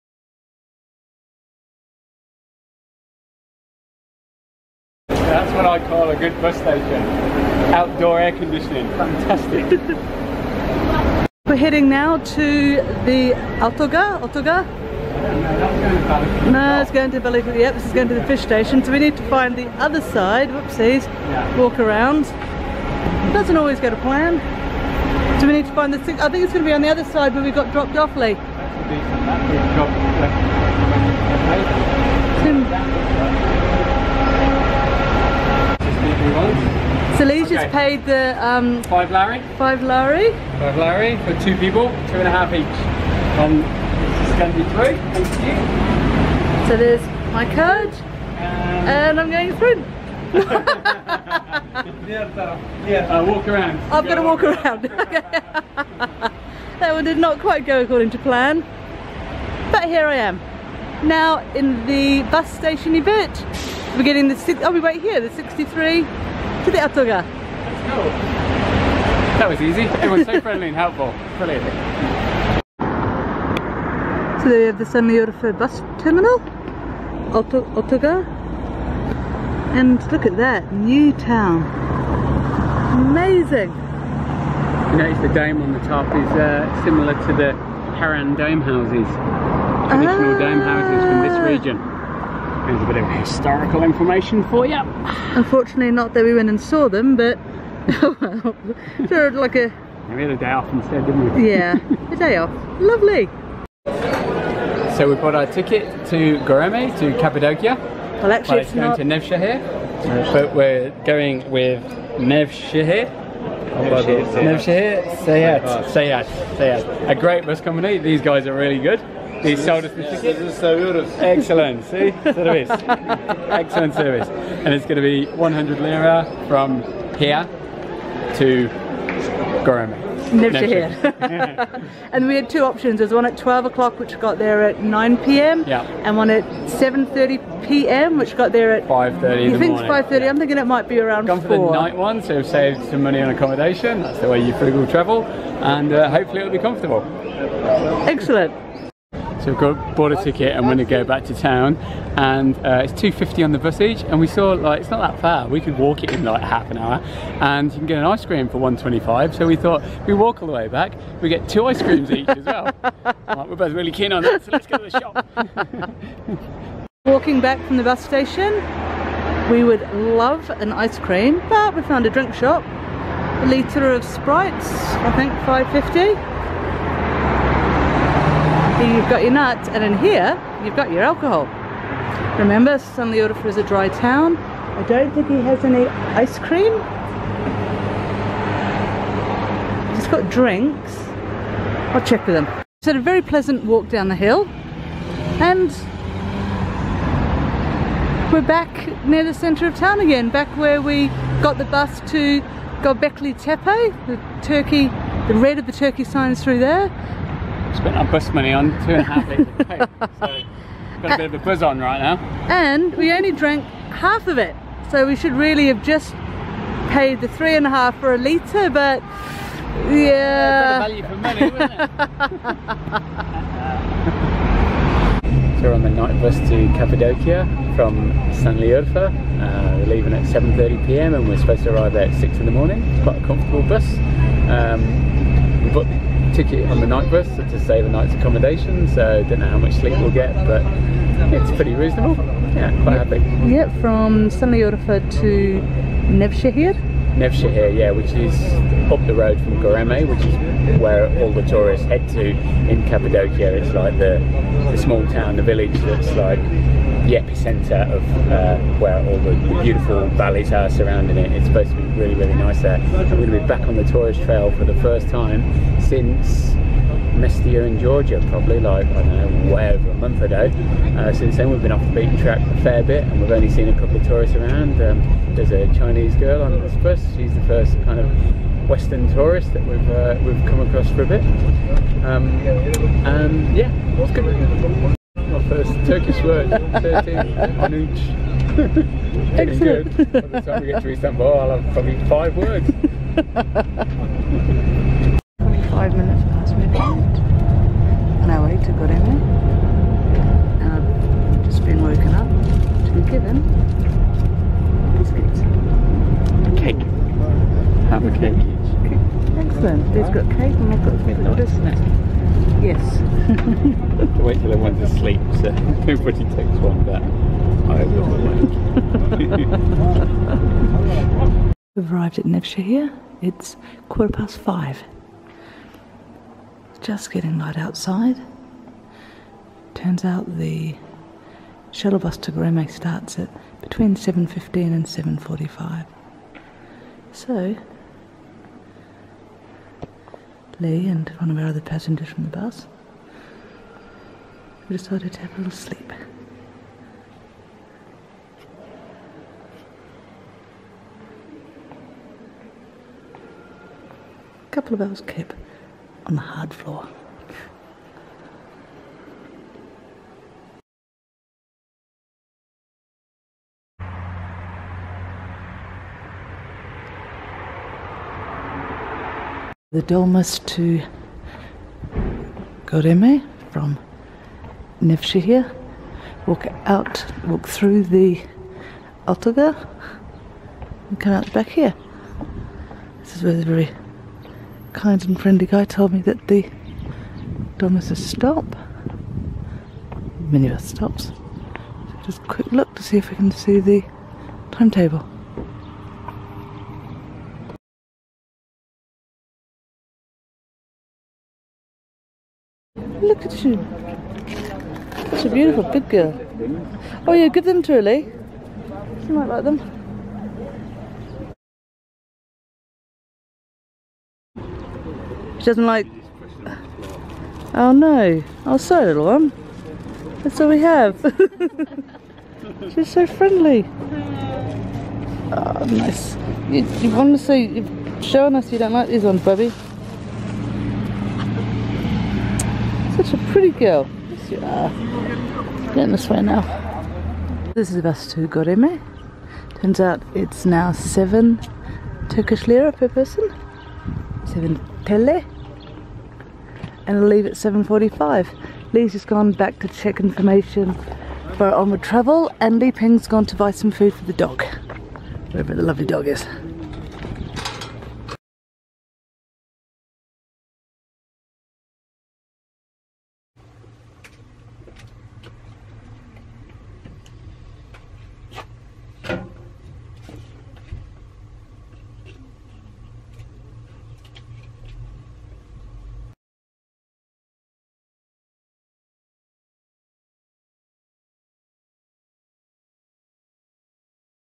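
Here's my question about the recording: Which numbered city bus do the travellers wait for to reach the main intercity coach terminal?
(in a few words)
63.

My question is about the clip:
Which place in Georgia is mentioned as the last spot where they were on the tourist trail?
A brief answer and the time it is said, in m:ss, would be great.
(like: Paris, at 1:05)
Mestia, at 4:27.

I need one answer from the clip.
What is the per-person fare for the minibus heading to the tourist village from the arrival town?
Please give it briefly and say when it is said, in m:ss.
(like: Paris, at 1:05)
7 Turkish lira, at 7:20.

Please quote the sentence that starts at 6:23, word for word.
This is where the very kind and friendly guy told me that the Dolmus is stop.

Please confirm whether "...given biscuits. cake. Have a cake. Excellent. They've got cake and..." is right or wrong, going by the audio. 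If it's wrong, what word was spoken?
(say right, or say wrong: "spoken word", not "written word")
right.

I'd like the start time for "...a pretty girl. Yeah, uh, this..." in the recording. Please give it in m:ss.
7:13.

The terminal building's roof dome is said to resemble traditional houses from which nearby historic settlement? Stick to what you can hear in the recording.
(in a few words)
Harran.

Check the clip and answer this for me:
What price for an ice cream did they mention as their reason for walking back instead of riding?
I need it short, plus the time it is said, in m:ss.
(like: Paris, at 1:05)
125, at 2:38.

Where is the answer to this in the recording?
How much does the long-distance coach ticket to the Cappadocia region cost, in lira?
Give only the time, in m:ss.
2:05.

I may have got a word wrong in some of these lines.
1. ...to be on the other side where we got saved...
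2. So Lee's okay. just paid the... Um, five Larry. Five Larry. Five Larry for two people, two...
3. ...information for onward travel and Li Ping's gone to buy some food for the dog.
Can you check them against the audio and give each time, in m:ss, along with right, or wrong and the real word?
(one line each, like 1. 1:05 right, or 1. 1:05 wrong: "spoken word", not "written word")
1. 0:26 wrong: "dropped", not "saved"
2. 0:37 right
3. 7:29 right.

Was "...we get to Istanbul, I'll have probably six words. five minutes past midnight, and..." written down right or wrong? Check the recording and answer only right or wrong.
wrong.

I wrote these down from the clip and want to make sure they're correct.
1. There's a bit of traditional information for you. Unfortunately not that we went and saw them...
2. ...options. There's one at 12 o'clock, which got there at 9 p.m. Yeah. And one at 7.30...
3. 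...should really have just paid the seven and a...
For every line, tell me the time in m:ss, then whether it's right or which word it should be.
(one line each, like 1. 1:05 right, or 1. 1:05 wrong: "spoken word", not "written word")
1. 1:32 wrong: "historical", not "traditional"
2. 2:12 right
3. 3:35 wrong: "three", not "seven".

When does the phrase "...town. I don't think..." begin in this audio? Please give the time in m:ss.
3:03.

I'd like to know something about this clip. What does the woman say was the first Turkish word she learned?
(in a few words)
Manuç.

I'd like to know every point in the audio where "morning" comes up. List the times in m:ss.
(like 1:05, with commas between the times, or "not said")
3:52.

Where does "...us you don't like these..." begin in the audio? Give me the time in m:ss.
7:08.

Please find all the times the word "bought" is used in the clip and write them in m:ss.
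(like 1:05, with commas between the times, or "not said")
1:45, 2:29, 3:55.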